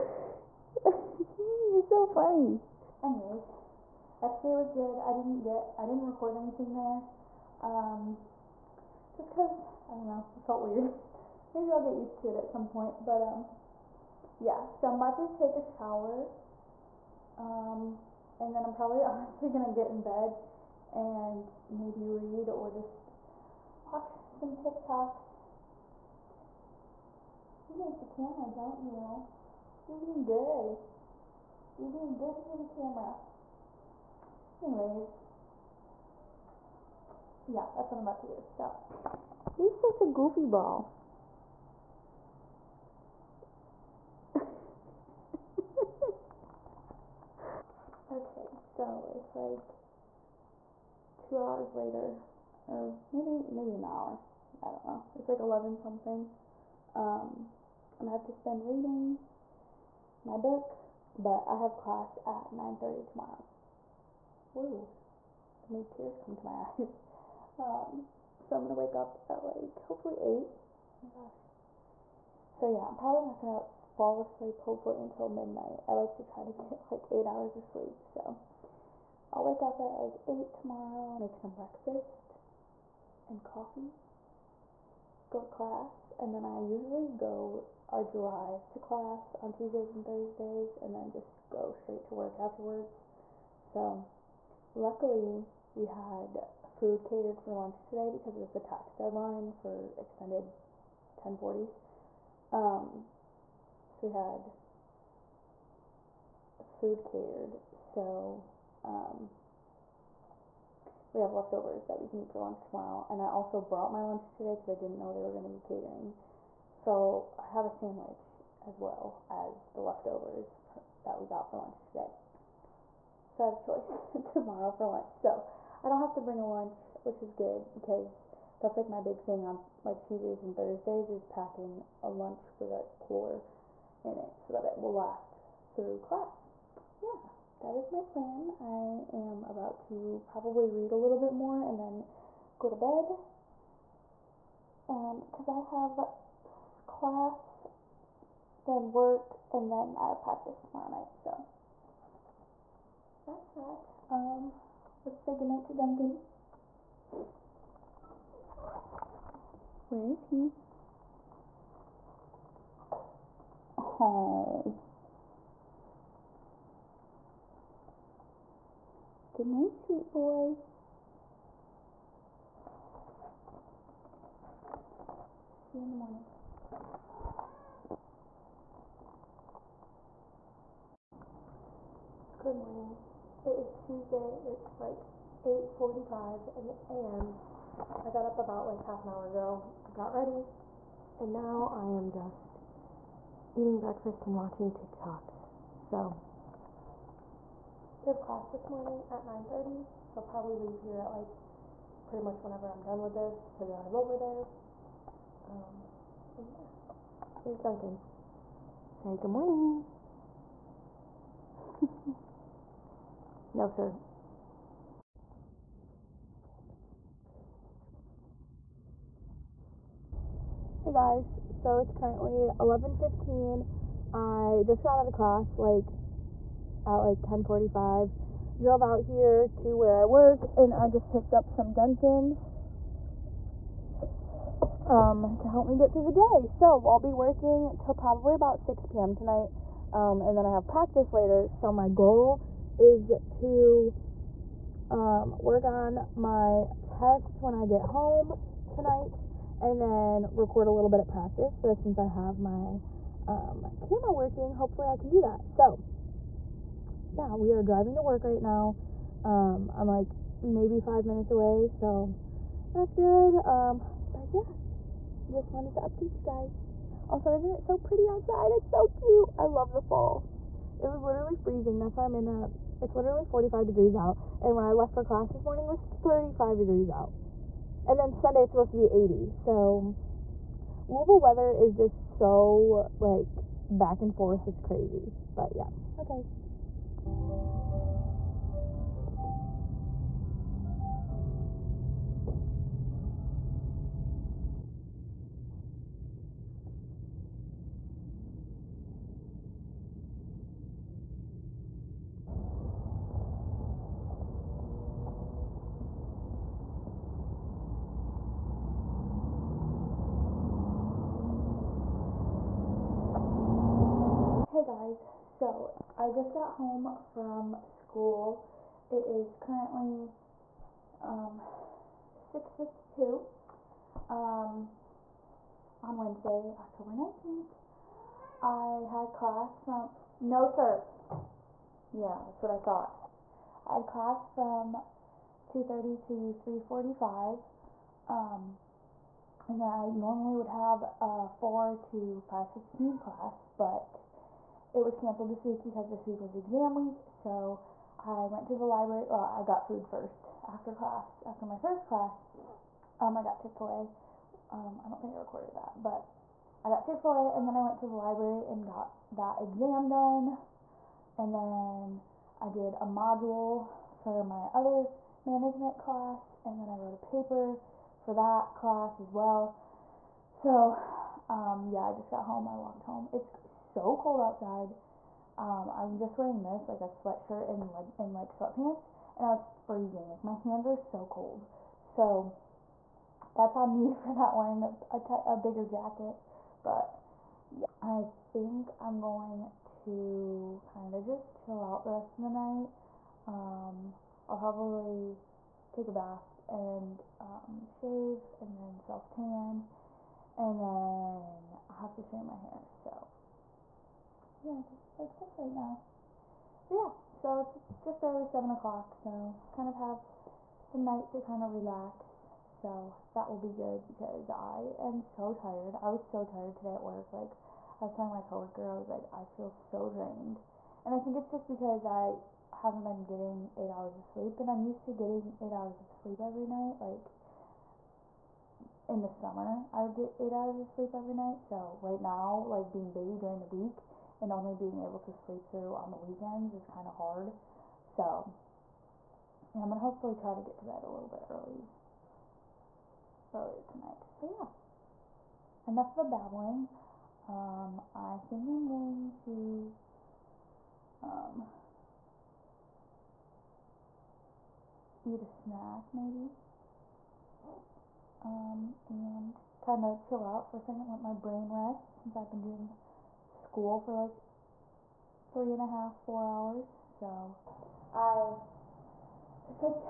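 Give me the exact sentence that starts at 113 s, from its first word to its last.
And I also brought my lunch today because I didn't know they were going to be catering.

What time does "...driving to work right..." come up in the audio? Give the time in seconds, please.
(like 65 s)
257 s.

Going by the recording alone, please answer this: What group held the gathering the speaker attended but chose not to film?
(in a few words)
FCA.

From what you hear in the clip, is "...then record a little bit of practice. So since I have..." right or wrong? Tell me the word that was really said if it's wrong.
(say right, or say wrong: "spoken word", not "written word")
right.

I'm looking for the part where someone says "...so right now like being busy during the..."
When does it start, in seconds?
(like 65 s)
431 s.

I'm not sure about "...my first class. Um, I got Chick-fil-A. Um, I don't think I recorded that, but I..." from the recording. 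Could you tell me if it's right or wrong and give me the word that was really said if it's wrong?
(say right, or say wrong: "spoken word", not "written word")
right.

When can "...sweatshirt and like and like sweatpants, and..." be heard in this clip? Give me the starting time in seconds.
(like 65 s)
376 s.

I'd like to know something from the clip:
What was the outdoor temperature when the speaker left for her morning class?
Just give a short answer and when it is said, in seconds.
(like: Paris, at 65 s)
35 degrees, at 275 s.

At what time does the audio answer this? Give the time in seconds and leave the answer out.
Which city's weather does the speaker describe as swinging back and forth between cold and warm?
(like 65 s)
280 s.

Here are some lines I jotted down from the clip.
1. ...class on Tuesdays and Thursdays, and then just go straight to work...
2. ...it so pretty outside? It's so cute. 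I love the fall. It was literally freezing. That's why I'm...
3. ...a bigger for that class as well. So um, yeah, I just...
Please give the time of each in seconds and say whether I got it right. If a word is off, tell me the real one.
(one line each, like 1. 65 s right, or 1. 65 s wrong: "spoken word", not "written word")
1. 88 s right
2. 267 s right
3. 366 s wrong: "paper", not "bigger".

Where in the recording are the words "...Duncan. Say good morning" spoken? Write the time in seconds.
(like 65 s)
207 s.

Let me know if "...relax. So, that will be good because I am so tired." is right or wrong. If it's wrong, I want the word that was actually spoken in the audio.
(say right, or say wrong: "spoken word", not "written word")
right.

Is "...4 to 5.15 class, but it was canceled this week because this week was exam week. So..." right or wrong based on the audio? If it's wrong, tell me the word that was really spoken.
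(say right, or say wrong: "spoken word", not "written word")
right.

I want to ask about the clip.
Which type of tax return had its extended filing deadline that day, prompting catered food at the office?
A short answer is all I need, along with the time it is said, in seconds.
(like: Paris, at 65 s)
1040s, at 99 s.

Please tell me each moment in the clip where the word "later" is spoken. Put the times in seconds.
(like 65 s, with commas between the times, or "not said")
51 s, 241 s.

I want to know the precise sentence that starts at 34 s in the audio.
Anyways, yeah, that's what I'm about to do.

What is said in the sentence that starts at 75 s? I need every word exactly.
I like to try to get like 8 hours of sleep.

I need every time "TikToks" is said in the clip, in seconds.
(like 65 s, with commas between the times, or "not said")
24 s, 194 s.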